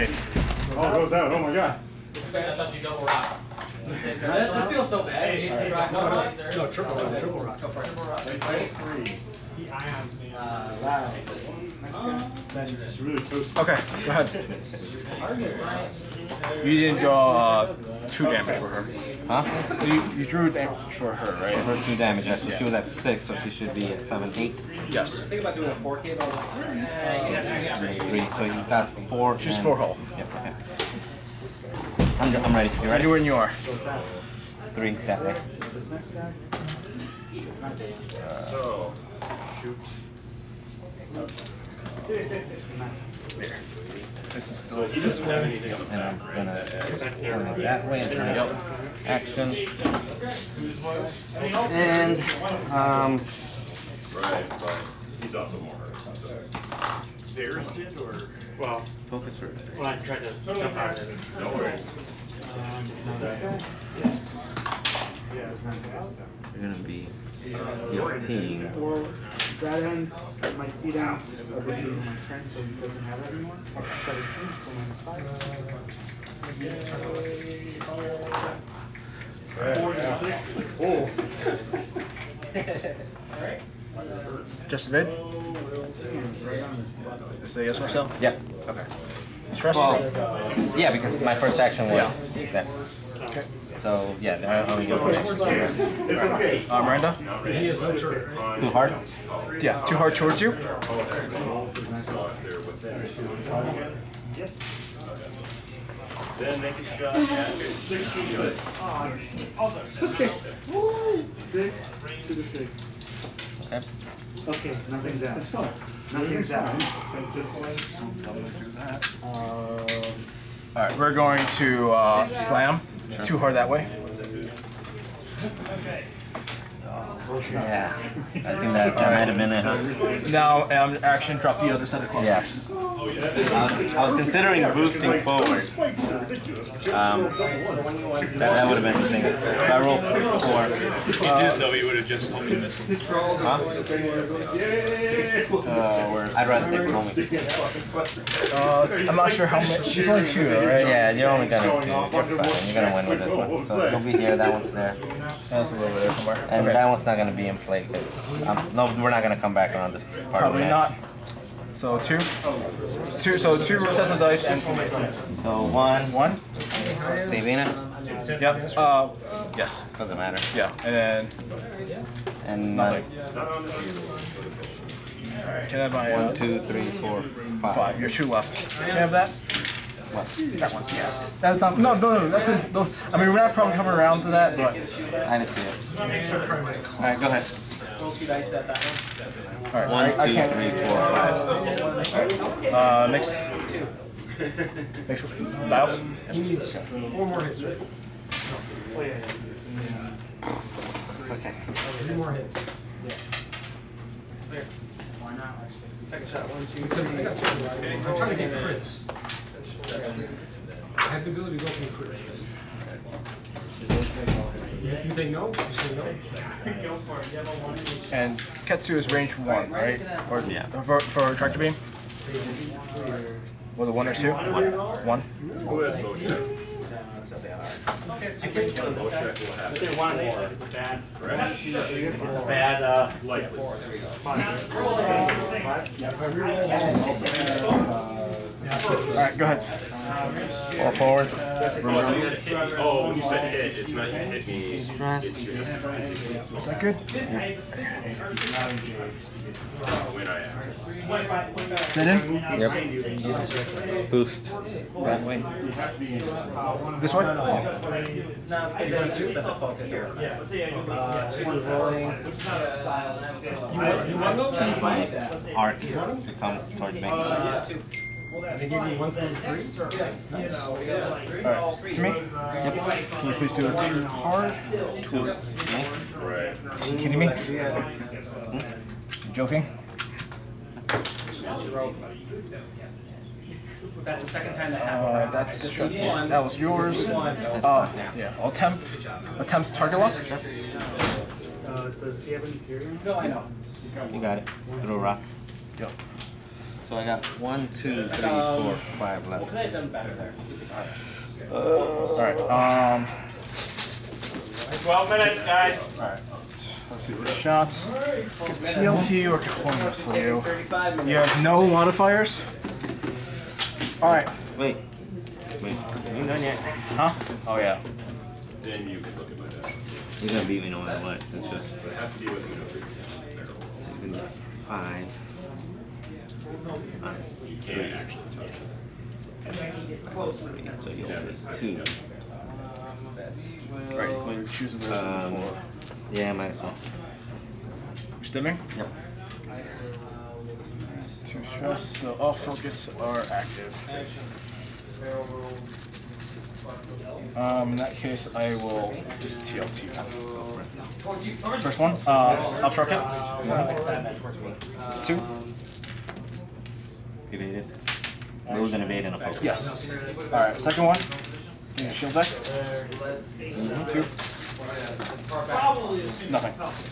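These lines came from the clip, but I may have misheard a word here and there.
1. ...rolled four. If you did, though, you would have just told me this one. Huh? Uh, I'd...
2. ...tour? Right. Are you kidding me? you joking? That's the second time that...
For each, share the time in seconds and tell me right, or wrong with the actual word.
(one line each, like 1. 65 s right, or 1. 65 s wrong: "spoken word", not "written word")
1. 139 s right
2. 275 s right.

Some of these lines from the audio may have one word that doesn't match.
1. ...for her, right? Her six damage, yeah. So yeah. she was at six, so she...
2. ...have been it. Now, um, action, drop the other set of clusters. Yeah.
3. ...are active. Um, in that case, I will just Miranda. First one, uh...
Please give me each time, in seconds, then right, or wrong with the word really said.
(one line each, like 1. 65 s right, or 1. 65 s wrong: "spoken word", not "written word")
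1. 20 s wrong: "two", not "six"
2. 129 s right
3. 342 s wrong: "TLT", not "Miranda".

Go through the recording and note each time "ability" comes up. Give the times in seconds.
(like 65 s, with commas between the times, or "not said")
211 s.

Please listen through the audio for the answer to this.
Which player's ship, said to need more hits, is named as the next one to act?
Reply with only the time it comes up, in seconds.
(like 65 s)
195 s.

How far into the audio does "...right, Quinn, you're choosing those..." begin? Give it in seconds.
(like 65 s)
333 s.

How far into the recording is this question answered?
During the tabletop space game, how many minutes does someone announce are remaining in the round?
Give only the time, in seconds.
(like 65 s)
304 s.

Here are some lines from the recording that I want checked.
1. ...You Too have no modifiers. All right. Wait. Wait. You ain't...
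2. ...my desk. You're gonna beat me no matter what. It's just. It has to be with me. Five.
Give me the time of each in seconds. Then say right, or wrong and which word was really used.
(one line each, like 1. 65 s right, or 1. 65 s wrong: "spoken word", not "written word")
1. 310 s wrong: "You", not "Too"
2. 319 s right.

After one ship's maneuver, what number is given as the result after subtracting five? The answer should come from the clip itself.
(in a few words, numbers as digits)
46.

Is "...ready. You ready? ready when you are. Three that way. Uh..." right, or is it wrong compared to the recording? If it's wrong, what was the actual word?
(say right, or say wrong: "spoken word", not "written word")
right.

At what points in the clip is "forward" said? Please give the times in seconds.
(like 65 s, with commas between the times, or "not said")
135 s, 240 s.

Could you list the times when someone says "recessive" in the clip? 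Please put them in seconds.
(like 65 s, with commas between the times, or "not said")
163 s.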